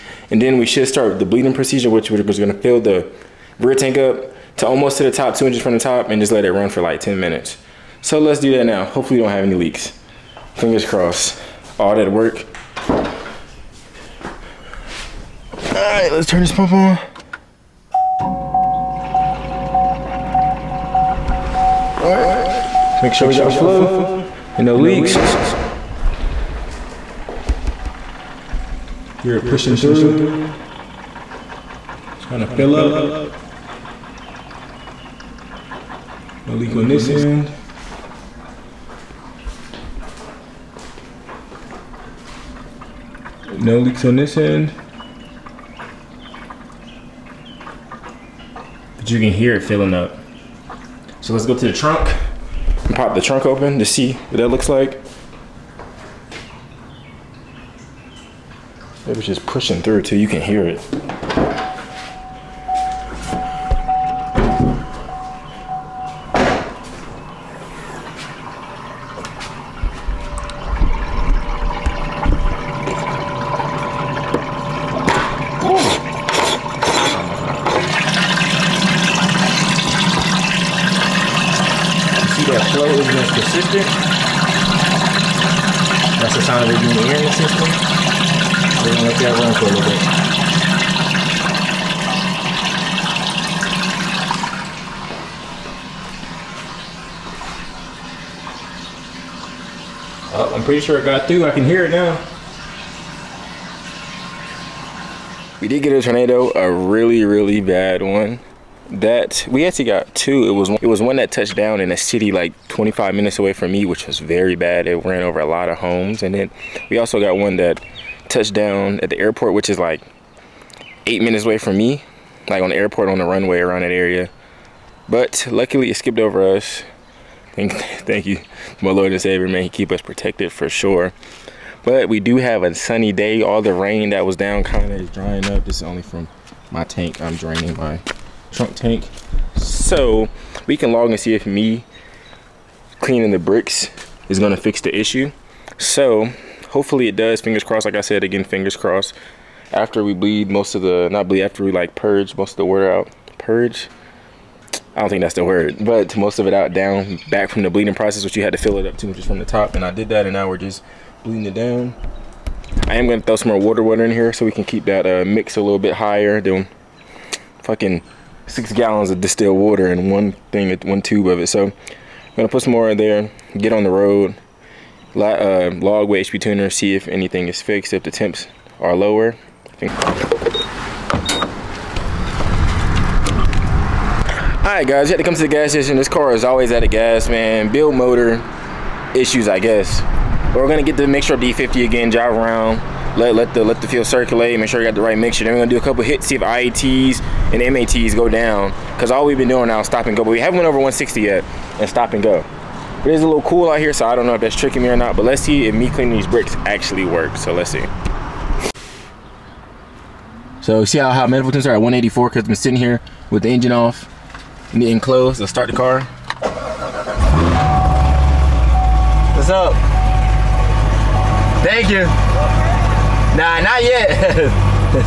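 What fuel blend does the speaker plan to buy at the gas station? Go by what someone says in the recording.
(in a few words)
E50.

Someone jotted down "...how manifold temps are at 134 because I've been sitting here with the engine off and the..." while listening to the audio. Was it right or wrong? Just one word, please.
wrong.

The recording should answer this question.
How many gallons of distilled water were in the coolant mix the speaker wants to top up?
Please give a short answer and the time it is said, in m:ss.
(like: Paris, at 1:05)
6, at 2:48.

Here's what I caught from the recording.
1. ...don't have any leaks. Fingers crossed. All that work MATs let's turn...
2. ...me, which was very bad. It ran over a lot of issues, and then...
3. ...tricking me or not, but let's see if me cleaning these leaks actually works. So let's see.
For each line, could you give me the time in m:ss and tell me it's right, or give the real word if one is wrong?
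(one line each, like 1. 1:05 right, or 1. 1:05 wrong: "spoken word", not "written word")
1. 0:09 wrong: "All", not "MATs"
2. 1:53 wrong: "homes", not "issues"
3. 3:24 wrong: "bricks", not "leaks".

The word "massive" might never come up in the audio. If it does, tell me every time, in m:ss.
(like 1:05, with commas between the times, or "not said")
not said.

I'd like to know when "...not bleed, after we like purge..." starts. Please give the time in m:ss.
2:31.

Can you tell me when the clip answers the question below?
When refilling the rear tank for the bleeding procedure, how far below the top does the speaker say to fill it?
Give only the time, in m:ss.
0:05.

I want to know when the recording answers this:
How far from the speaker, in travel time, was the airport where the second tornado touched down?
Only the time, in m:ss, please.
2:01.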